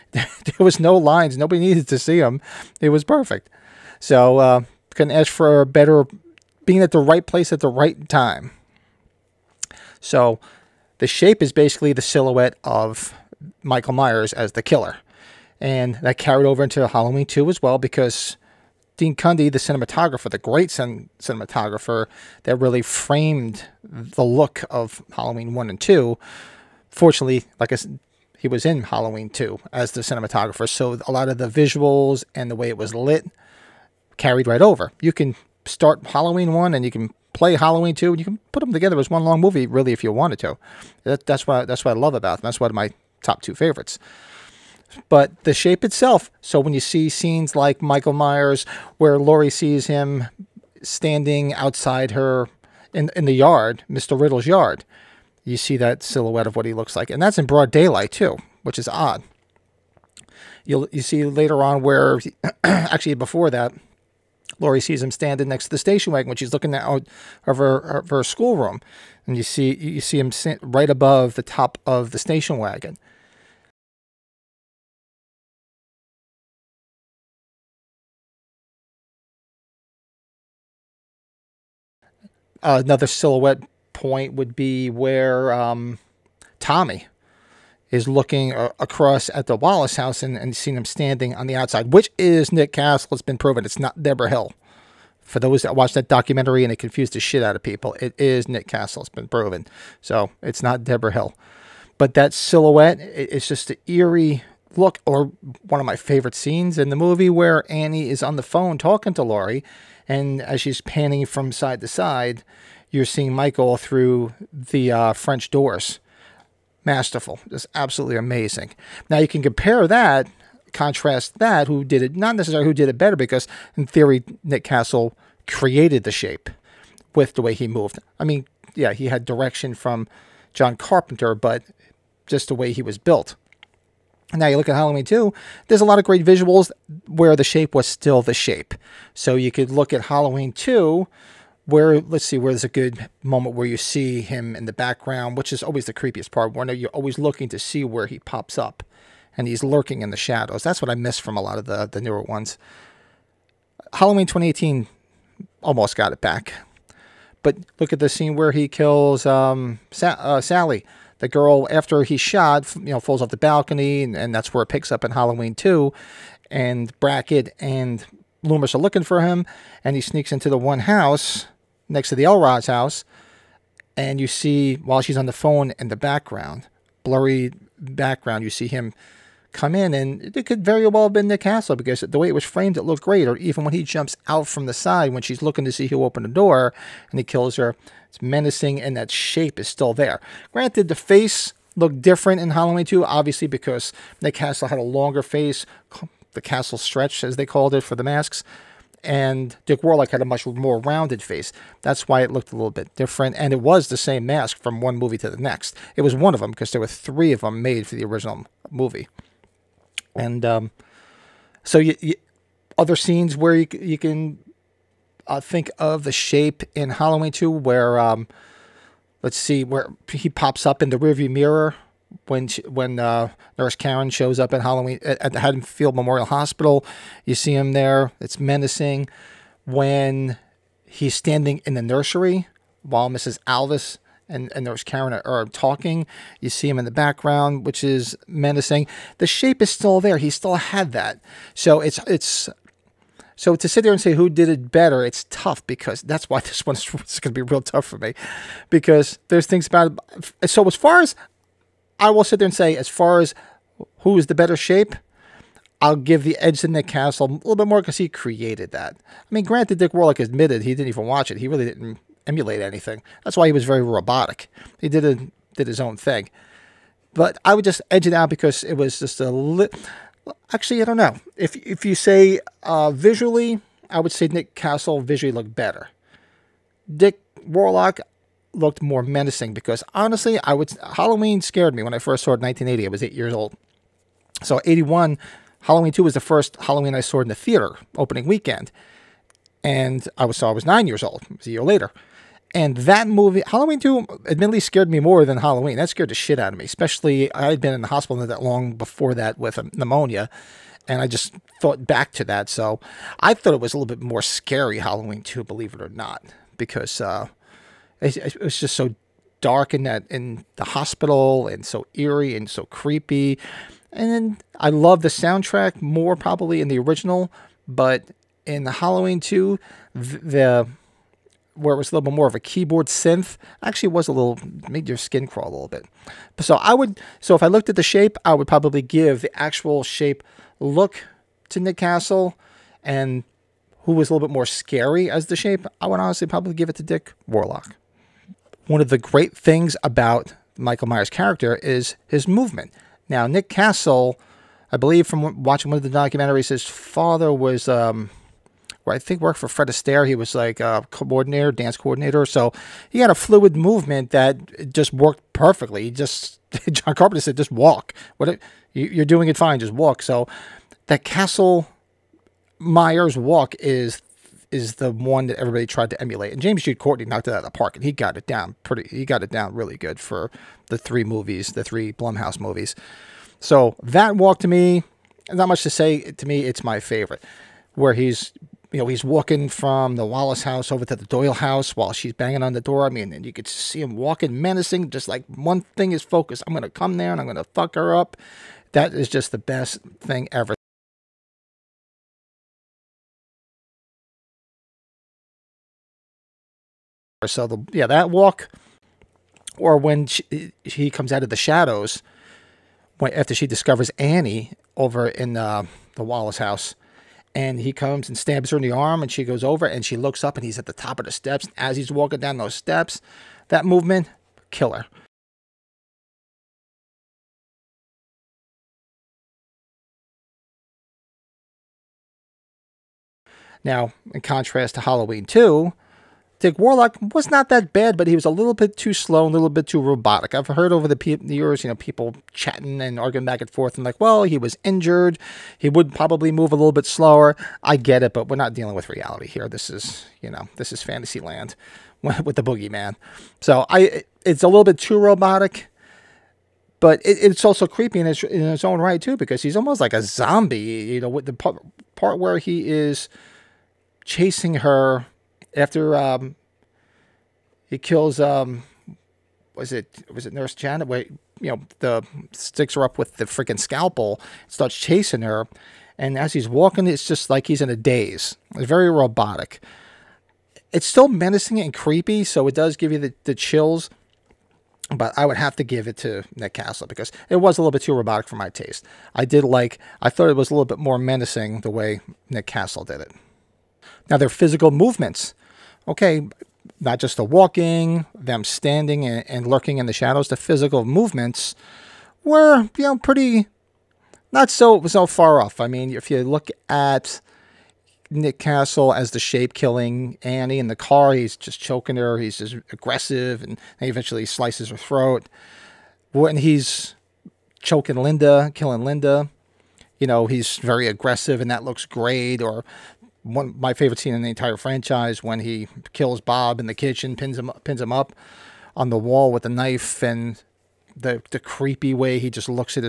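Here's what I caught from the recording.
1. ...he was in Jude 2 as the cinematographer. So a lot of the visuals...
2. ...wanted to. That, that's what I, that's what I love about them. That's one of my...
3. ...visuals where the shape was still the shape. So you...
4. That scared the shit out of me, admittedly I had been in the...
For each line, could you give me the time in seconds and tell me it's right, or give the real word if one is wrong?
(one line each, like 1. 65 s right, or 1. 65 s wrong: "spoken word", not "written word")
1. 28 s wrong: "Halloween", not "Jude"
2. 40 s right
3. 136 s right
4. 295 s wrong: "especially", not "admittedly".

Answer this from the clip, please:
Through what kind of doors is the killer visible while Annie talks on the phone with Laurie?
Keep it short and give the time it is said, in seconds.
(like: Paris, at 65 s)
French doors, at 115 s.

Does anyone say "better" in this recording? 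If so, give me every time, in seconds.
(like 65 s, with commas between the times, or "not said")
5 s, 122 s, 244 s, 254 s, 275 s.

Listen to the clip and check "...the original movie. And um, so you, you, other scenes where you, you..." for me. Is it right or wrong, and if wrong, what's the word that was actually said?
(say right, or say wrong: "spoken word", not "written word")
right.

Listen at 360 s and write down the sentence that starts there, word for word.
So that Castle Myers walk is is the one that everybody tried to emulate.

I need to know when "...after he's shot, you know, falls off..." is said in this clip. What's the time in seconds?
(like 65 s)
161 s.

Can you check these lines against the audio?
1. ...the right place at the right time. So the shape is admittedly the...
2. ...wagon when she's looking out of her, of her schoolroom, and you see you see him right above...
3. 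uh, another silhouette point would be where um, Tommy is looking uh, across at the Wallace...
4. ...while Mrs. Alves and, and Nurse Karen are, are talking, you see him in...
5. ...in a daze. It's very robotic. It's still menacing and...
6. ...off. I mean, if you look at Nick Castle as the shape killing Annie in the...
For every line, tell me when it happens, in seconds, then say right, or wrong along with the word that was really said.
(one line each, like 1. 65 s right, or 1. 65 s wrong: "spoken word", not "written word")
1. 6 s wrong: "basically", not "admittedly"
2. 66 s right
3. 82 s right
4. 232 s right
5. 467 s right
6. 495 s right.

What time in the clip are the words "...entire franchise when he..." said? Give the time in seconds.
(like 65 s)
514 s.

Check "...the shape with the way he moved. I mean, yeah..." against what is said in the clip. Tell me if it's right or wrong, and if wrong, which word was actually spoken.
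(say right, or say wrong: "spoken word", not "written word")
right.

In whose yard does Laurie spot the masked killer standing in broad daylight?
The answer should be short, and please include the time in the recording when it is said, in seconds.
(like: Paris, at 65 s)
Mr. Riddle's, at 53 s.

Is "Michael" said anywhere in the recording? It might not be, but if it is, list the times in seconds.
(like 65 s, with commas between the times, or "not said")
13 s, 47 s, 113 s, 340 s.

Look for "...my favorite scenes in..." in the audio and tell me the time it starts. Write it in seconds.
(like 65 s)
105 s.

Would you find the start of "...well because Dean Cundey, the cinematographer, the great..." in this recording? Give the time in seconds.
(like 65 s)
17 s.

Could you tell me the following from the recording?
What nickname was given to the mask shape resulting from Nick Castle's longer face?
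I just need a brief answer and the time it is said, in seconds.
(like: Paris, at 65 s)
The Castle stretch, at 196 s.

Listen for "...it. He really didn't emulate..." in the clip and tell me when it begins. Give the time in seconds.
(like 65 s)
261 s.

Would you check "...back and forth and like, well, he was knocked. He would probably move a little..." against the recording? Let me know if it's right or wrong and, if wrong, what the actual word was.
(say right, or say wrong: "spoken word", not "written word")
wrong: "injured", not "knocked".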